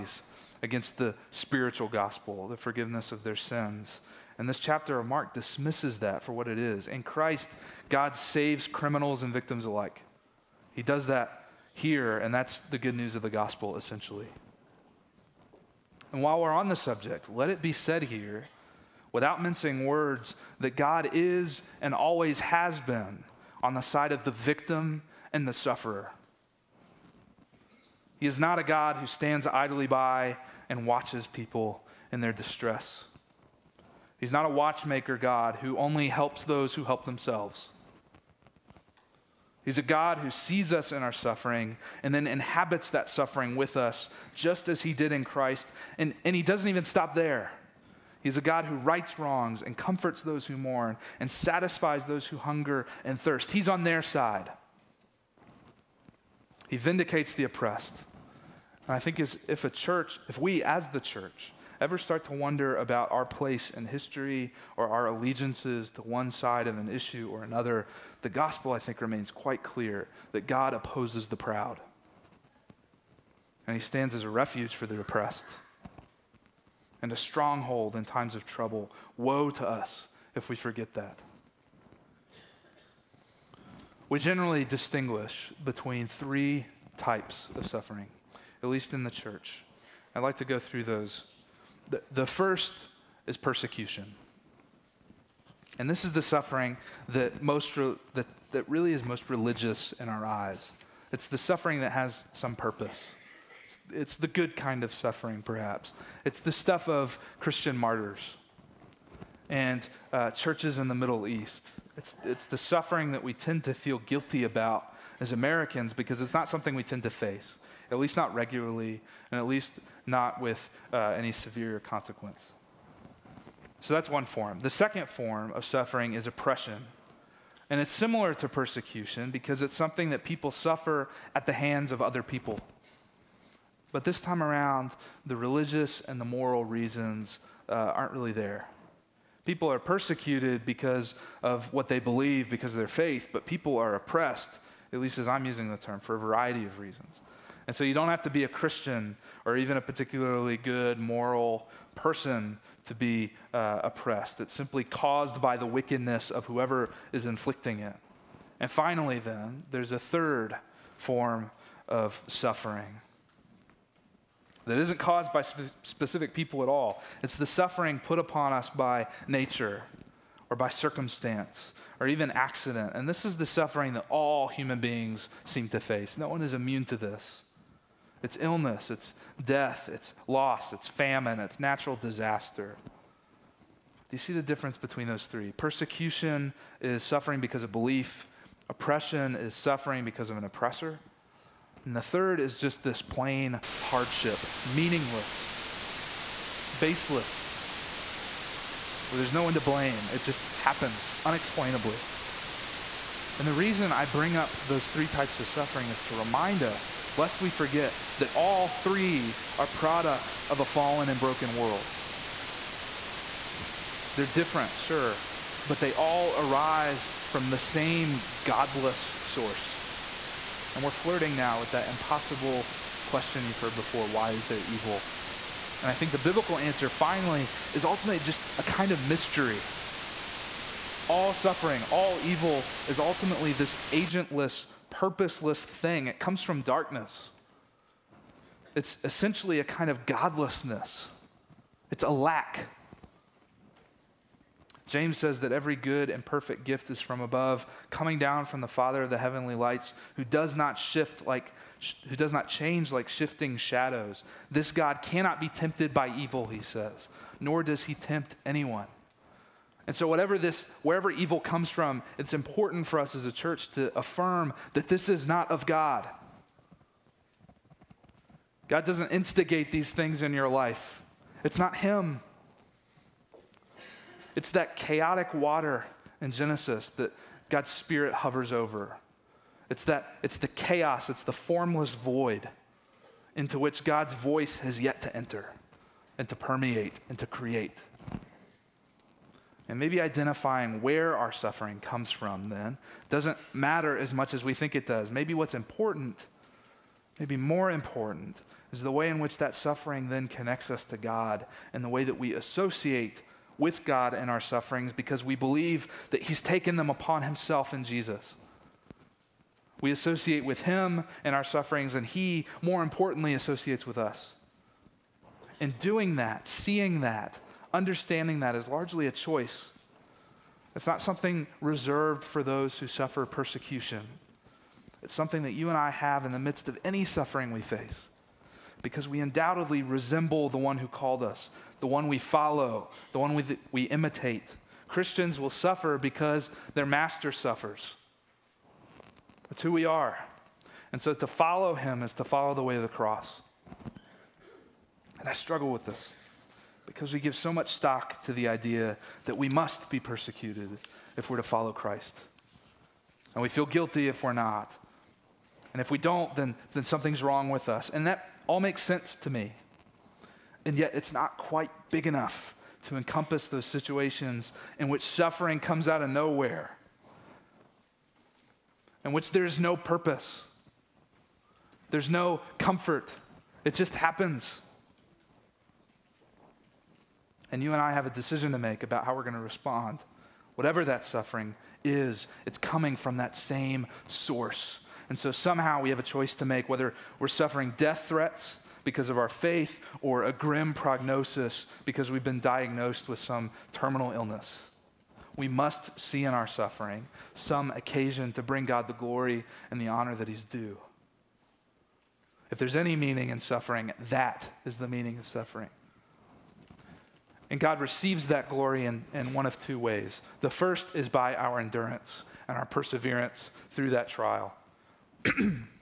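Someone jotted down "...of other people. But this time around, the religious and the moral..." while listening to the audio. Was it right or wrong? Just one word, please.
right.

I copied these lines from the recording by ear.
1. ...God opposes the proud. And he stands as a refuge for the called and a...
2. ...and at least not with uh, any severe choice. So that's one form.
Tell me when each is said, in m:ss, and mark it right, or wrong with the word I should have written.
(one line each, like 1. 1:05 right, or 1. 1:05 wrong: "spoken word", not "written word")
1. 1:10 wrong: "oppressed", not "called"
2. 1:59 wrong: "consequence", not "choice".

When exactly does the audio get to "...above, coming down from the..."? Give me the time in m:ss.
4:07.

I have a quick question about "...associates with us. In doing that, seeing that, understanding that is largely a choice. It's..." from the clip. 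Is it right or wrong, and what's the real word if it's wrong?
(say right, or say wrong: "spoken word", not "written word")
right.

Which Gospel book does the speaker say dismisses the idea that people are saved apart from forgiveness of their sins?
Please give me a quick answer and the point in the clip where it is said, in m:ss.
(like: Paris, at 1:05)
Mark, at 0:05.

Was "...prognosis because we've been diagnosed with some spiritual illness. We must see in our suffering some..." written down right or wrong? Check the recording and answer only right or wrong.
wrong.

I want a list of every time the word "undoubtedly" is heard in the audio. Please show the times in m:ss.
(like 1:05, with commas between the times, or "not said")
5:29.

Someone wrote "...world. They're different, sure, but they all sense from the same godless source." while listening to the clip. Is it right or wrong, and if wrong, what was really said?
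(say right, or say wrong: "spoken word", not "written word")
wrong: "arise", not "sense".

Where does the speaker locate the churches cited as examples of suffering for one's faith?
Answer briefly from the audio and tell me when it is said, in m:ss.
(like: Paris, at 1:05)
Middle East, at 1:50.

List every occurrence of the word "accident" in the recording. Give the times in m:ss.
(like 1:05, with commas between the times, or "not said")
2:52.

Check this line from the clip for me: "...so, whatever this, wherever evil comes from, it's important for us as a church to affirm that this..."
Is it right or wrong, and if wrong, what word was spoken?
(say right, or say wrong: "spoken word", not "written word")
right.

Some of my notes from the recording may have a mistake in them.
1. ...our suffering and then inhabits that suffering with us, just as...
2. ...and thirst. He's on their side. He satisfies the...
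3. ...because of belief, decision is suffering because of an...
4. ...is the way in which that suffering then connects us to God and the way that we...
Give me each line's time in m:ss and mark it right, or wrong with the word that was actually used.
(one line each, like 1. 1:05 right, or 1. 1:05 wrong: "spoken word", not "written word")
1. 0:41 right
2. 0:53 wrong: "vindicates", not "satisfies"
3. 3:07 wrong: "oppression", not "decision"
4. 4:58 right.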